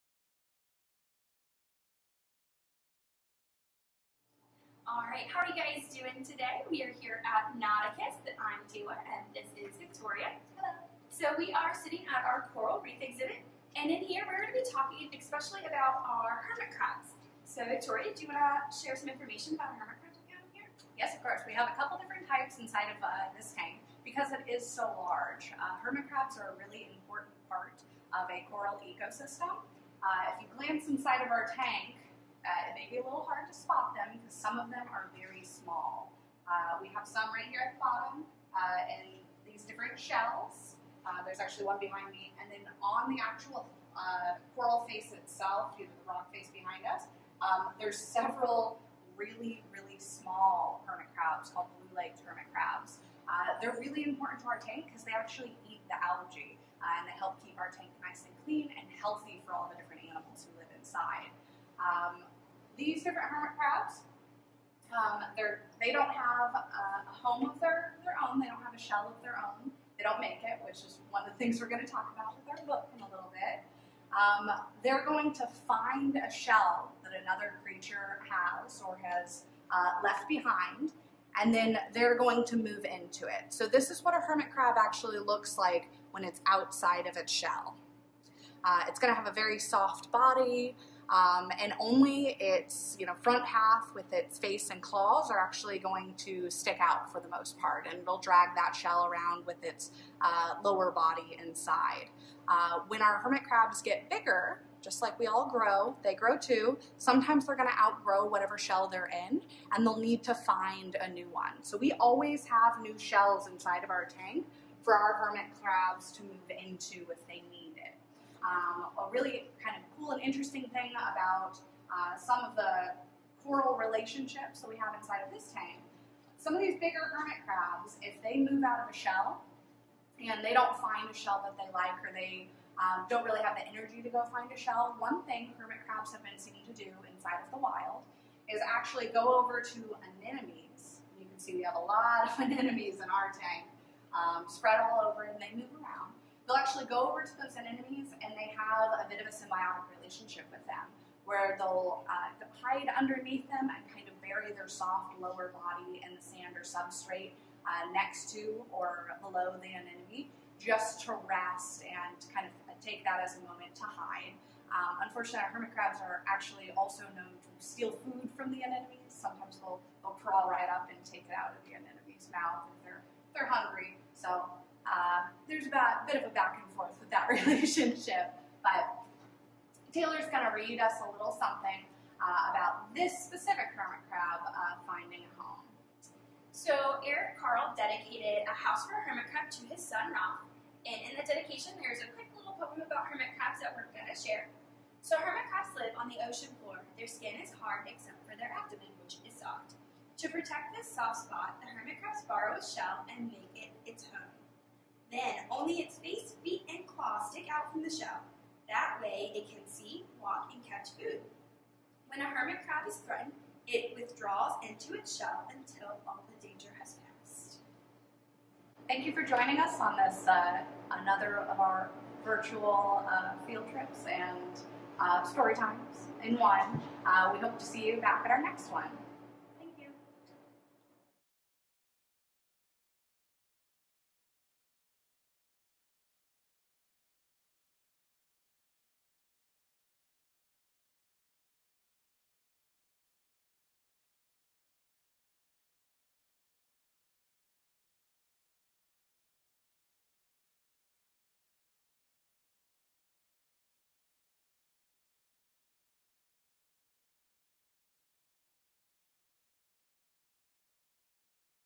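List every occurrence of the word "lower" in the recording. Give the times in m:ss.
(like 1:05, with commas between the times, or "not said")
1:40, 2:35.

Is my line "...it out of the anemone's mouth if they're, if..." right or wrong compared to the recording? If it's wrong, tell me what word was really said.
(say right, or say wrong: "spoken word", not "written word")
right.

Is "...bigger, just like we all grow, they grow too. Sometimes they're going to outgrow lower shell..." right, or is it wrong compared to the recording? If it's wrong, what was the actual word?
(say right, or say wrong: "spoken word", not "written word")
wrong: "whatever", not "lower".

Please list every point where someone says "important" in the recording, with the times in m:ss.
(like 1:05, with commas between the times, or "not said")
0:26, 0:54.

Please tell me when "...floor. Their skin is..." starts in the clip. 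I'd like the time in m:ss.
3:16.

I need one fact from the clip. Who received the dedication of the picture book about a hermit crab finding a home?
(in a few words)
His son Ralph.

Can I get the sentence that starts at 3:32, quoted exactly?
is threatened, it withdraws into its shell until all the danger has passed.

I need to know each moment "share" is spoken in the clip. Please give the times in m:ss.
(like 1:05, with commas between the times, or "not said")
0:18, 3:14.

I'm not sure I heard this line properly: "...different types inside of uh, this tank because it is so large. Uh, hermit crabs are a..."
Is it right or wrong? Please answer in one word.
right.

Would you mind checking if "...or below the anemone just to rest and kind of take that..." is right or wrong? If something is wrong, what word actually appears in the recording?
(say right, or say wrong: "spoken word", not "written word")
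right.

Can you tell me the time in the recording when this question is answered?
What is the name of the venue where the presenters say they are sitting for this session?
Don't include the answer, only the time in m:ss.
0:07.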